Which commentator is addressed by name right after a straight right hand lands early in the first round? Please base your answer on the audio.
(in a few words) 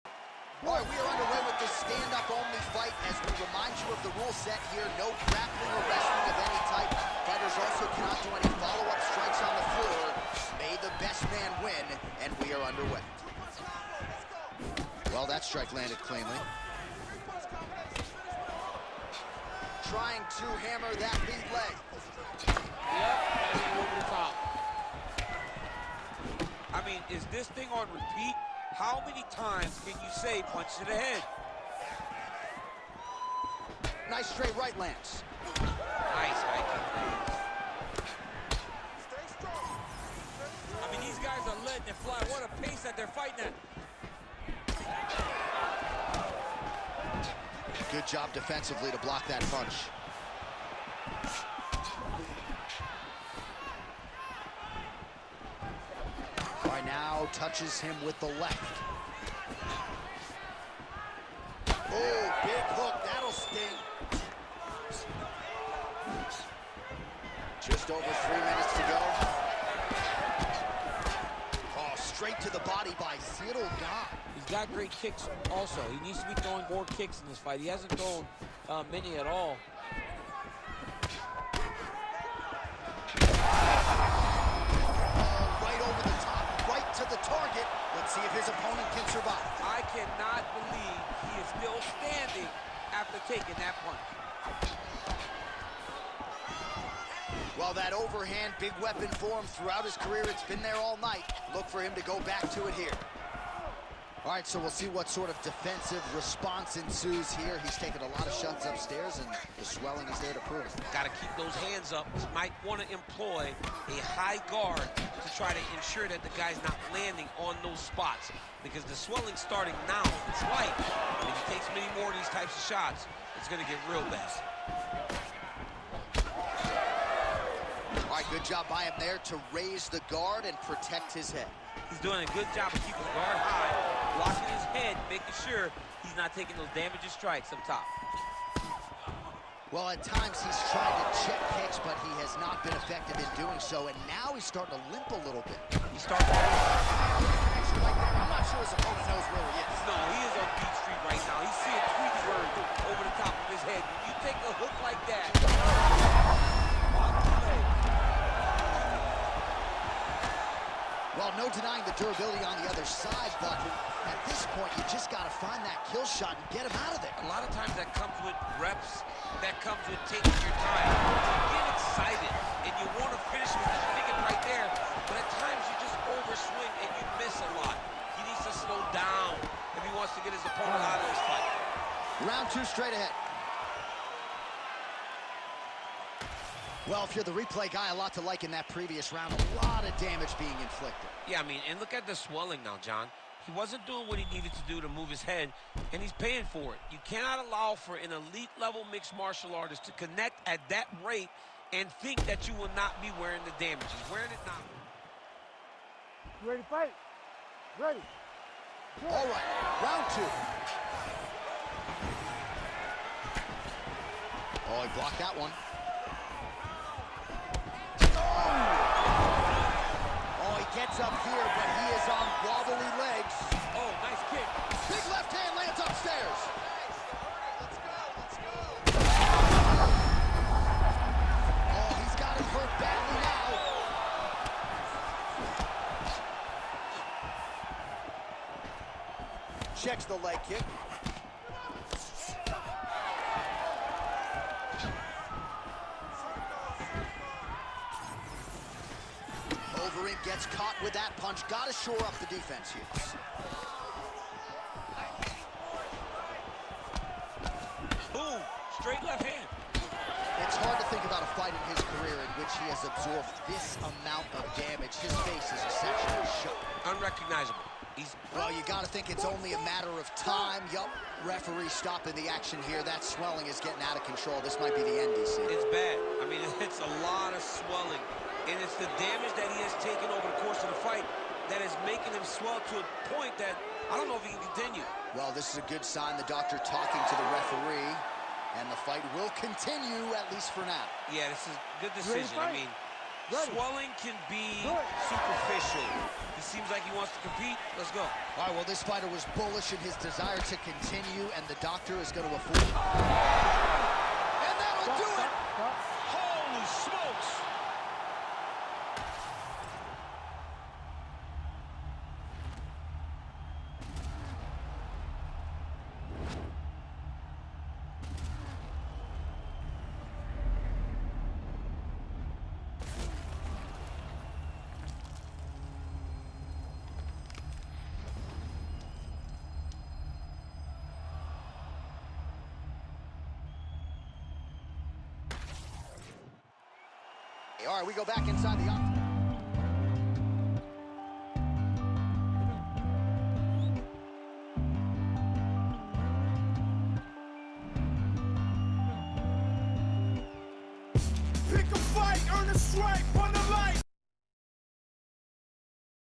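Lance.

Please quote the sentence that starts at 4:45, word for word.
Well, this is a good sign, the doctor talking to the referee, and the fight will continue, at least for now.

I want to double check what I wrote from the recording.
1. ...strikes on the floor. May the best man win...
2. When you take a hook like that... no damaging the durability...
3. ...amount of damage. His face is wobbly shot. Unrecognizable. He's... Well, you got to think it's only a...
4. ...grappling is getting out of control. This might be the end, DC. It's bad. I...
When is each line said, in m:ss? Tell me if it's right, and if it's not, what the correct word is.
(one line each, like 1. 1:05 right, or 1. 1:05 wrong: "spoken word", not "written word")
1. 0:09 right
2. 2:33 wrong: "denying", not "damaging"
3. 4:23 wrong: "essentially", not "wobbly"
4. 4:33 wrong: "swelling", not "grappling".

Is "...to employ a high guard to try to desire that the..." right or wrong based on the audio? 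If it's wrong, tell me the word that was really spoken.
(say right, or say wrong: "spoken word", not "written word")
wrong: "ensure", not "desire".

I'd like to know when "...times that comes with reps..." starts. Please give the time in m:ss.
2:47.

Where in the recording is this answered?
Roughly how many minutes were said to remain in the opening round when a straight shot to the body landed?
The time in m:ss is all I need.
1:08.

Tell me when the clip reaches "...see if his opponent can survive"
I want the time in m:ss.
1:28.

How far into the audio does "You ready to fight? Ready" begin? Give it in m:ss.
3:26.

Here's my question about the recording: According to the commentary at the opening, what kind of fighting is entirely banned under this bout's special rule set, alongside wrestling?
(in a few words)
Grappling.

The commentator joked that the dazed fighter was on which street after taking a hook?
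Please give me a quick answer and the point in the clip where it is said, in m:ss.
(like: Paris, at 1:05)
Beach Street, at 2:30.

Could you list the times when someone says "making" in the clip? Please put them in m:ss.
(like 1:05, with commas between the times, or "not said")
2:15, 4:41.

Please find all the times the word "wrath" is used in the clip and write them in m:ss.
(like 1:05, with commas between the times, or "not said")
not said.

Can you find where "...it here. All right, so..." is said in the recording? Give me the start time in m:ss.
1:42.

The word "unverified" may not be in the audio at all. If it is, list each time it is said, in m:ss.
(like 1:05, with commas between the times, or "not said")
not said.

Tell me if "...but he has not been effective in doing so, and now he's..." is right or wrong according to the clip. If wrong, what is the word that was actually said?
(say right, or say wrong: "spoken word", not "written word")
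right.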